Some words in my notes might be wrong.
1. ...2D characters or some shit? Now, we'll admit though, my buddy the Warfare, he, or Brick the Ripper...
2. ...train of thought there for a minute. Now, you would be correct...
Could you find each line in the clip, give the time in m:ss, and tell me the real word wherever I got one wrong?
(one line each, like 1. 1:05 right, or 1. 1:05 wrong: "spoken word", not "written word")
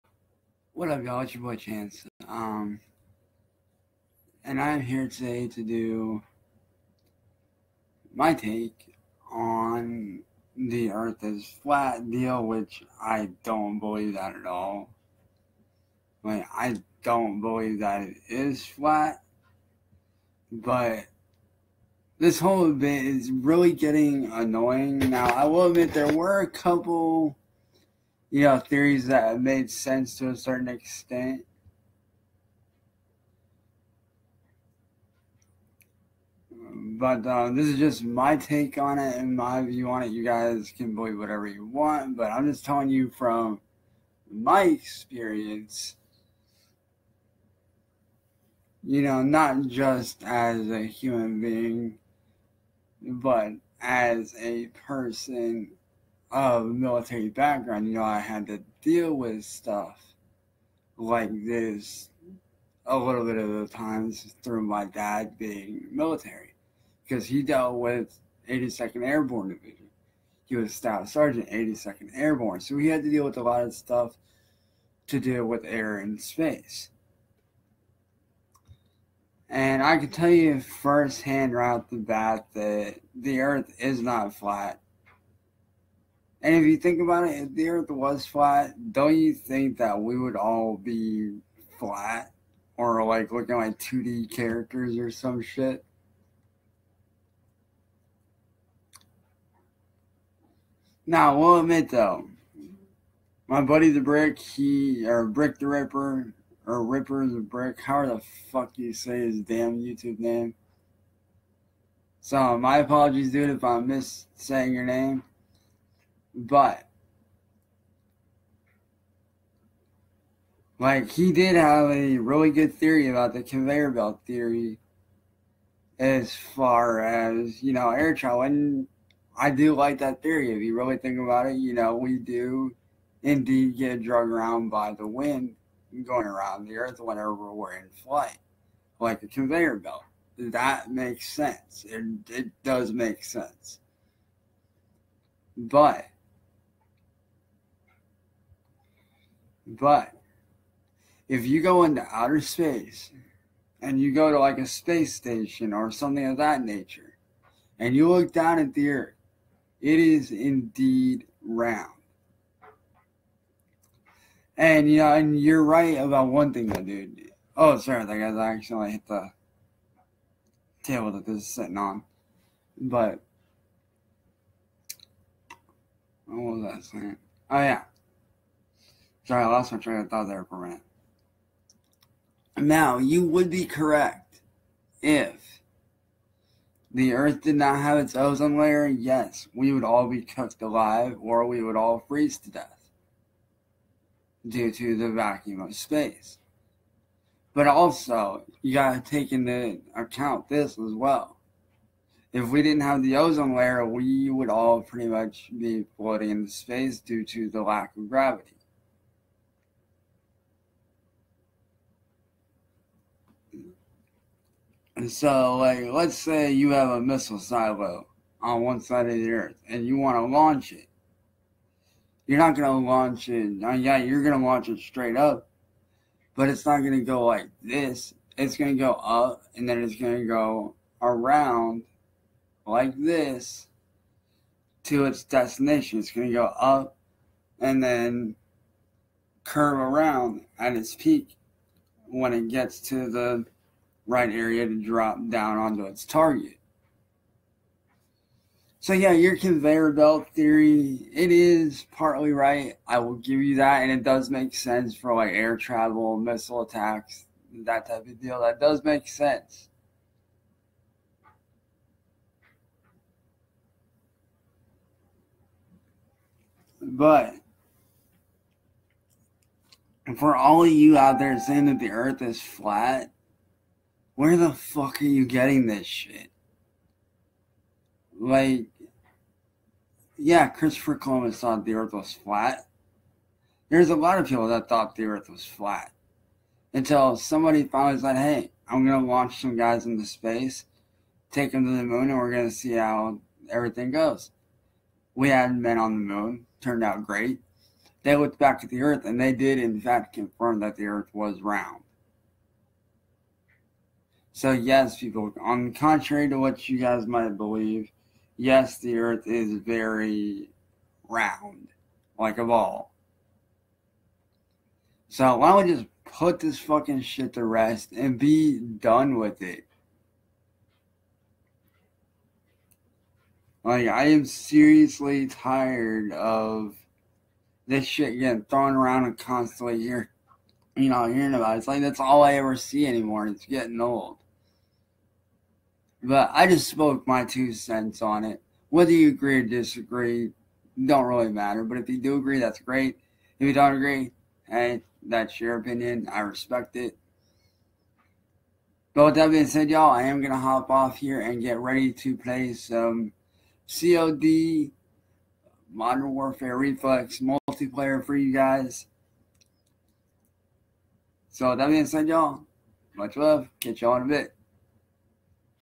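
1. 1:33 wrong: "Brick", not "Warfare"
2. 2:59 right.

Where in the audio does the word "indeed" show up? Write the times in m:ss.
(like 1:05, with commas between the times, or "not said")
2:13, 2:40.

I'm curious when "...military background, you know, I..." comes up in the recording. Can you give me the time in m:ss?
0:56.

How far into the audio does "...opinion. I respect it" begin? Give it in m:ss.
5:45.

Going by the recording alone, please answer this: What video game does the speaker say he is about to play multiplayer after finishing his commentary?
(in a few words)
COD Modern Warfare Reflex.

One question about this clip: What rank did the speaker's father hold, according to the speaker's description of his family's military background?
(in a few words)
Staff sergeant.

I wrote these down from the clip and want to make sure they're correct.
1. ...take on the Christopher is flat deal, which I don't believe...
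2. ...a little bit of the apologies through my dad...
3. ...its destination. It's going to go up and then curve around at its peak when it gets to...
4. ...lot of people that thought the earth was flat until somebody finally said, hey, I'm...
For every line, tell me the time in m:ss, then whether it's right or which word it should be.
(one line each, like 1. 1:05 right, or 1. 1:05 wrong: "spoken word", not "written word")
1. 0:08 wrong: "Earth", not "Christopher"
2. 1:02 wrong: "times", not "apologies"
3. 3:55 right
4. 4:43 right.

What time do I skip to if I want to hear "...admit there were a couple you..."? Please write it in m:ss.
0:25.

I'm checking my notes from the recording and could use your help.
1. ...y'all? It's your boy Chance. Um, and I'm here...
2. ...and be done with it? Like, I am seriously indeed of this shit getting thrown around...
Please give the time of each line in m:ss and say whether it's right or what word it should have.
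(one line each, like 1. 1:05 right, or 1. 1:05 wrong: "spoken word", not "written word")
1. 0:01 right
2. 5:17 wrong: "tired", not "indeed".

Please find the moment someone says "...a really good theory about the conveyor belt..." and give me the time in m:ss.
2:01.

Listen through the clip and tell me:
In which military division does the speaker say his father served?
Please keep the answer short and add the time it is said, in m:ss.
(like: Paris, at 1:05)
82nd Airborne Division, at 1:08.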